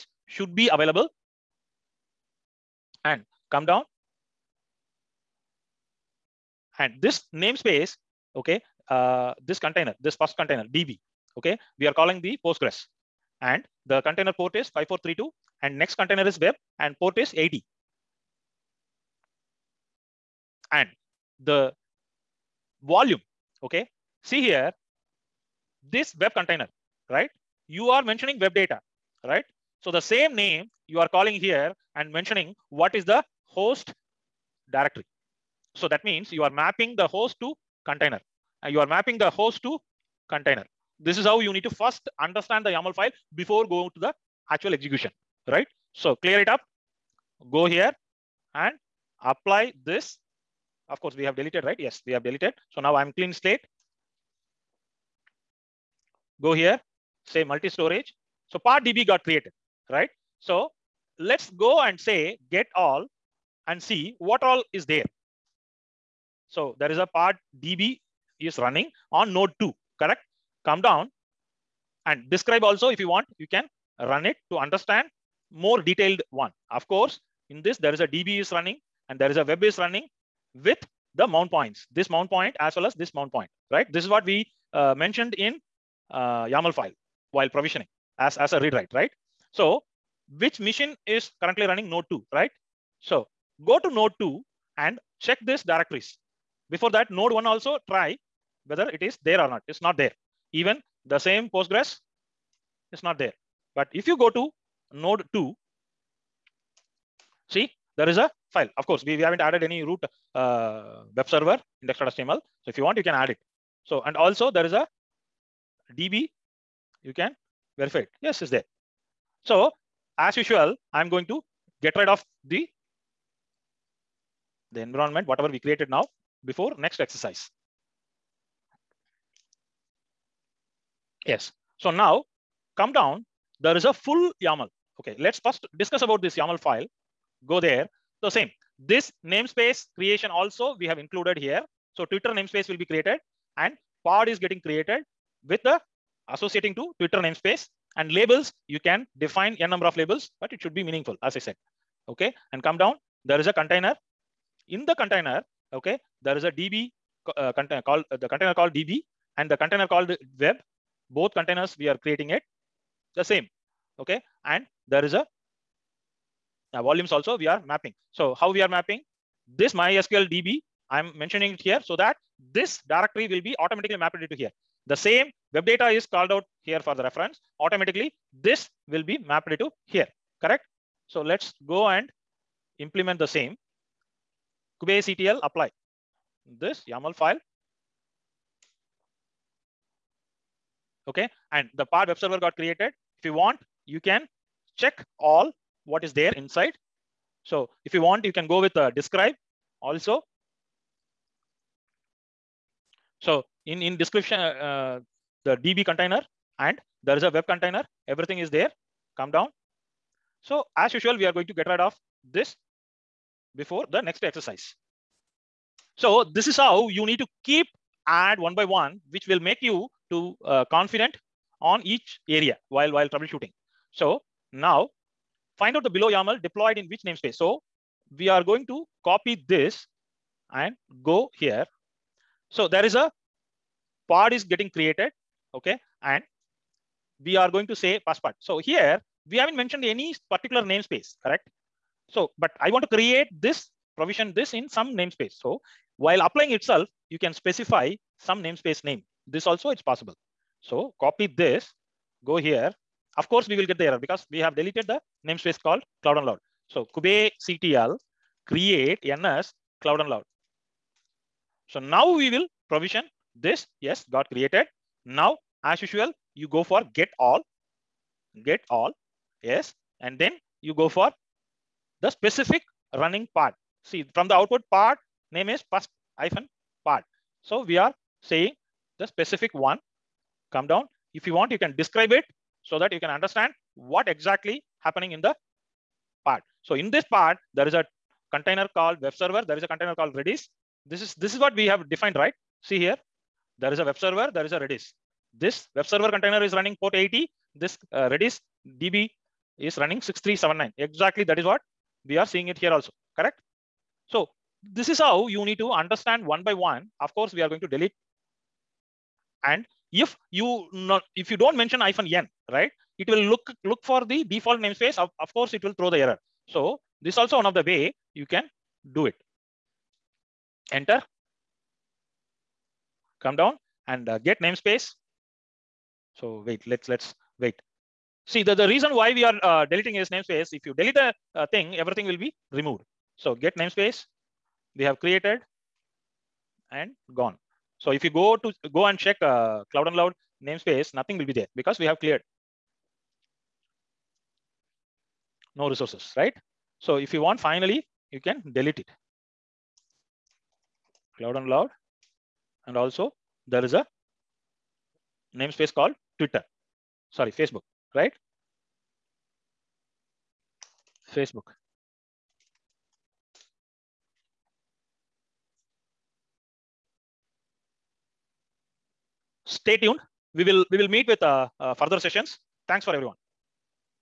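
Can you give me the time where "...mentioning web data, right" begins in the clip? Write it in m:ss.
0:28.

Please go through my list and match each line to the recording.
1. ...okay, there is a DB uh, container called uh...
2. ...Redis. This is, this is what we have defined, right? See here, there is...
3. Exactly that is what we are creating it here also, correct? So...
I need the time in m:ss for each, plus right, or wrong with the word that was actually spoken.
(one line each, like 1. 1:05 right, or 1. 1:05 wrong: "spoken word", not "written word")
1. 2:35 right
2. 4:50 right
3. 5:00 wrong: "seeing", not "creating".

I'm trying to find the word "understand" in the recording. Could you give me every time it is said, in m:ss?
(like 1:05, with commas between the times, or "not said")
0:42, 1:14, 4:43, 5:05.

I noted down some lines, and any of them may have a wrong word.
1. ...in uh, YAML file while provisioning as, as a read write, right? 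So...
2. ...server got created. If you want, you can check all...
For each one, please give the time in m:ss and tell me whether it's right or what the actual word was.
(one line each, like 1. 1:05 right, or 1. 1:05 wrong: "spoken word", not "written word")
1. 1:25 right
2. 3:12 right.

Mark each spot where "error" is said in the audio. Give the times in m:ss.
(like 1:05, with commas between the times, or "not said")
4:13, 5:15.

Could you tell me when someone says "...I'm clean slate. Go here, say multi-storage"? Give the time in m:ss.
0:52.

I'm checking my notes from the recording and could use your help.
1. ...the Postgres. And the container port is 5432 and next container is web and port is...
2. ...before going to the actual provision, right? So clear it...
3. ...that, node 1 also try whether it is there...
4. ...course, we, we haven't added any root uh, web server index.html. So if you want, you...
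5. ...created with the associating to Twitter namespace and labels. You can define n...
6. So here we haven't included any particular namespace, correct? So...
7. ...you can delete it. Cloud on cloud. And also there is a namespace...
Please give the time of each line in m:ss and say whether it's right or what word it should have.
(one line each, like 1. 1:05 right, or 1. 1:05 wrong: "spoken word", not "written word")
1. 0:12 right
2. 0:43 wrong: "execution", not "provision"
3. 1:36 right
4. 1:48 right
5. 2:24 right
6. 3:58 wrong: "mentioned", not "included"
7. 5:48 right.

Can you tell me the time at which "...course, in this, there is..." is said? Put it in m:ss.
1:16.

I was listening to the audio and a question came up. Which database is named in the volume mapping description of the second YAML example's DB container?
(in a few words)
MySQL.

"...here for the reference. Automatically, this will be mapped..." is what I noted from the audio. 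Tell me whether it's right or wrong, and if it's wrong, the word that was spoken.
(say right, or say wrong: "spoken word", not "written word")
right.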